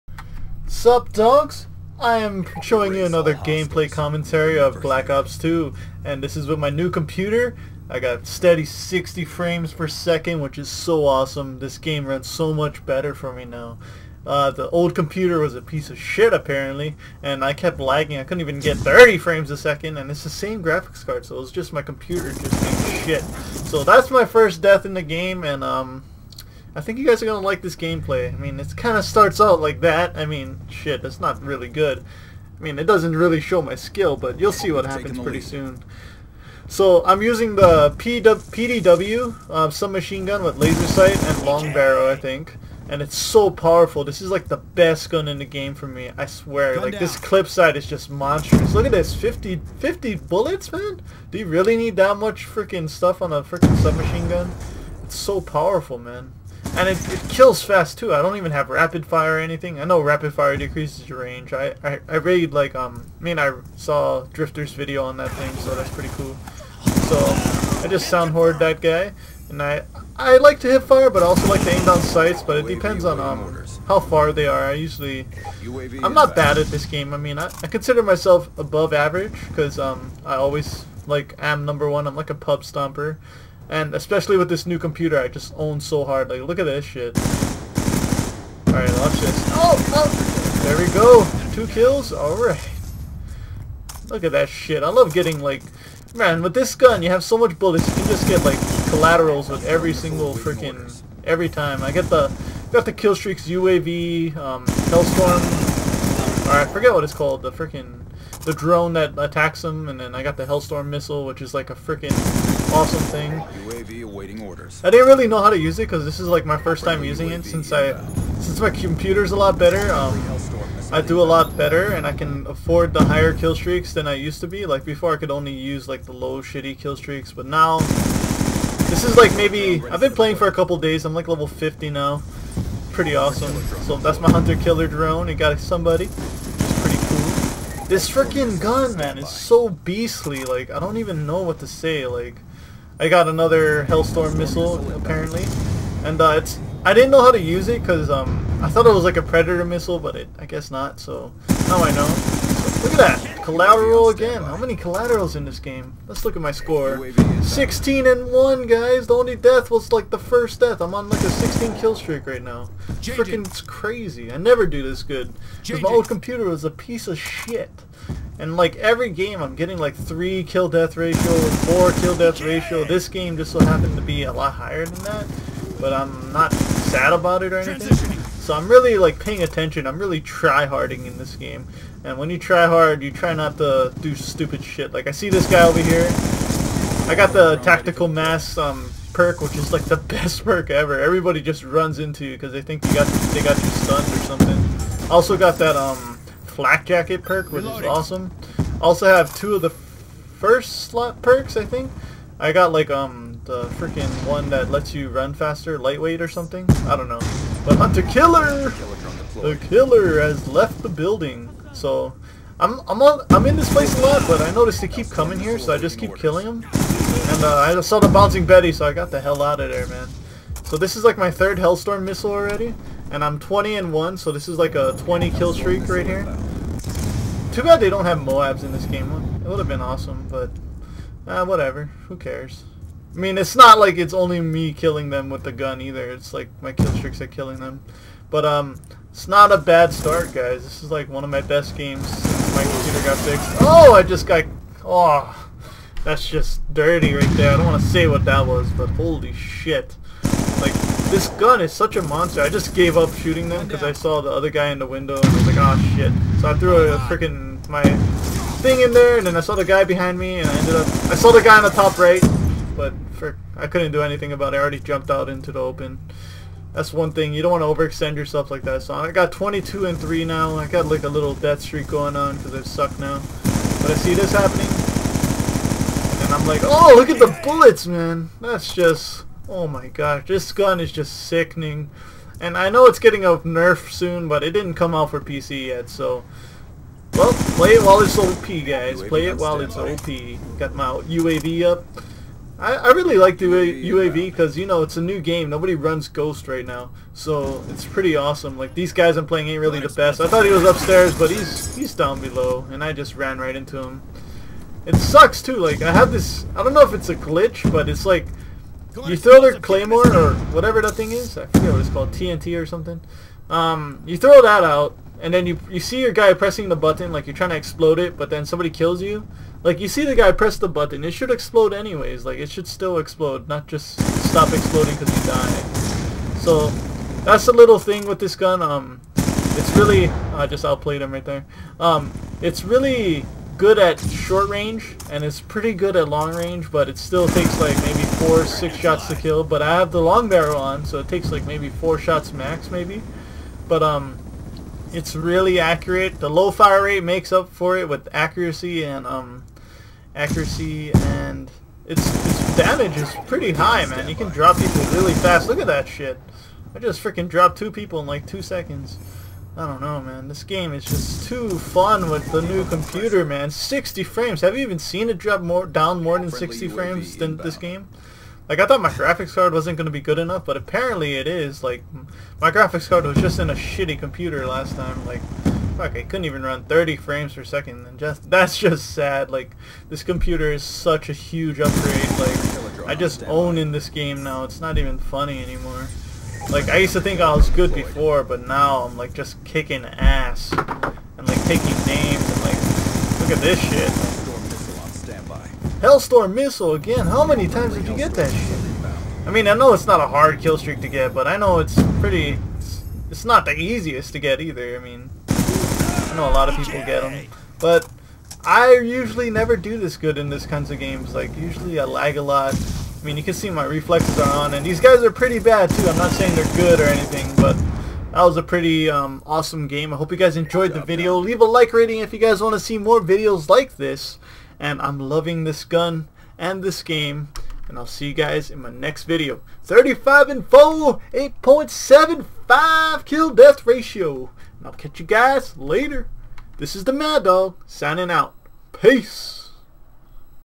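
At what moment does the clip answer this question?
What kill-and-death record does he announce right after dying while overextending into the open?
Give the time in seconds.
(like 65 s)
269 s.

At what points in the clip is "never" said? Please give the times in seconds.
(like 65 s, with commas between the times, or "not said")
164 s, 409 s.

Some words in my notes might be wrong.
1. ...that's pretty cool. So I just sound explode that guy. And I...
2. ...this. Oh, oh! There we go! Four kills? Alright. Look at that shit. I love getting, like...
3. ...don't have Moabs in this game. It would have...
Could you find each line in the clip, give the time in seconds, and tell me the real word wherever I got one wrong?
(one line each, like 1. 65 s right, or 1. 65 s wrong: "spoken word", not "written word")
1. 65 s wrong: "horde", not "explode"
2. 89 s wrong: "Two", not "Four"
3. 227 s right.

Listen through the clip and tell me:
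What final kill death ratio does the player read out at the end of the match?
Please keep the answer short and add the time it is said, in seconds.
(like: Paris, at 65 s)
8.75, at 431 s.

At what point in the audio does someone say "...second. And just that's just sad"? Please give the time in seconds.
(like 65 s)
377 s.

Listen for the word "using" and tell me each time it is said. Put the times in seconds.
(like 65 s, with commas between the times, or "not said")
37 s, 117 s.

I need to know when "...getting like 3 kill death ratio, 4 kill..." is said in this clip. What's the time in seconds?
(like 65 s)
169 s.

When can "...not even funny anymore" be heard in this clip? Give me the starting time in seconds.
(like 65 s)
384 s.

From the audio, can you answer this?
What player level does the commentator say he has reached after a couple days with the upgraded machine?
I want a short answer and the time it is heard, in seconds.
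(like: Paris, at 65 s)
level 50, at 131 s.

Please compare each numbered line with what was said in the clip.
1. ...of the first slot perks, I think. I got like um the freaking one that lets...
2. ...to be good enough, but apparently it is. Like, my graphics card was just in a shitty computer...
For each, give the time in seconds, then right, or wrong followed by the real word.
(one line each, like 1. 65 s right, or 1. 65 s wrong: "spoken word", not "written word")
1. 199 s right
2. 369 s right.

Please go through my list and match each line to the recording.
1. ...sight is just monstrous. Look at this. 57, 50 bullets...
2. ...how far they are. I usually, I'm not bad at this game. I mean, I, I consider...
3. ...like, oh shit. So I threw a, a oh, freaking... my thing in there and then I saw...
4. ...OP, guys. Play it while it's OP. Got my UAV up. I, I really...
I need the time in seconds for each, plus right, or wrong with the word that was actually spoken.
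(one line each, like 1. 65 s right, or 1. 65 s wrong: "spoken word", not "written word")
1. 47 s wrong: "50", not "57"
2. 73 s right
3. 255 s right
4. 288 s right.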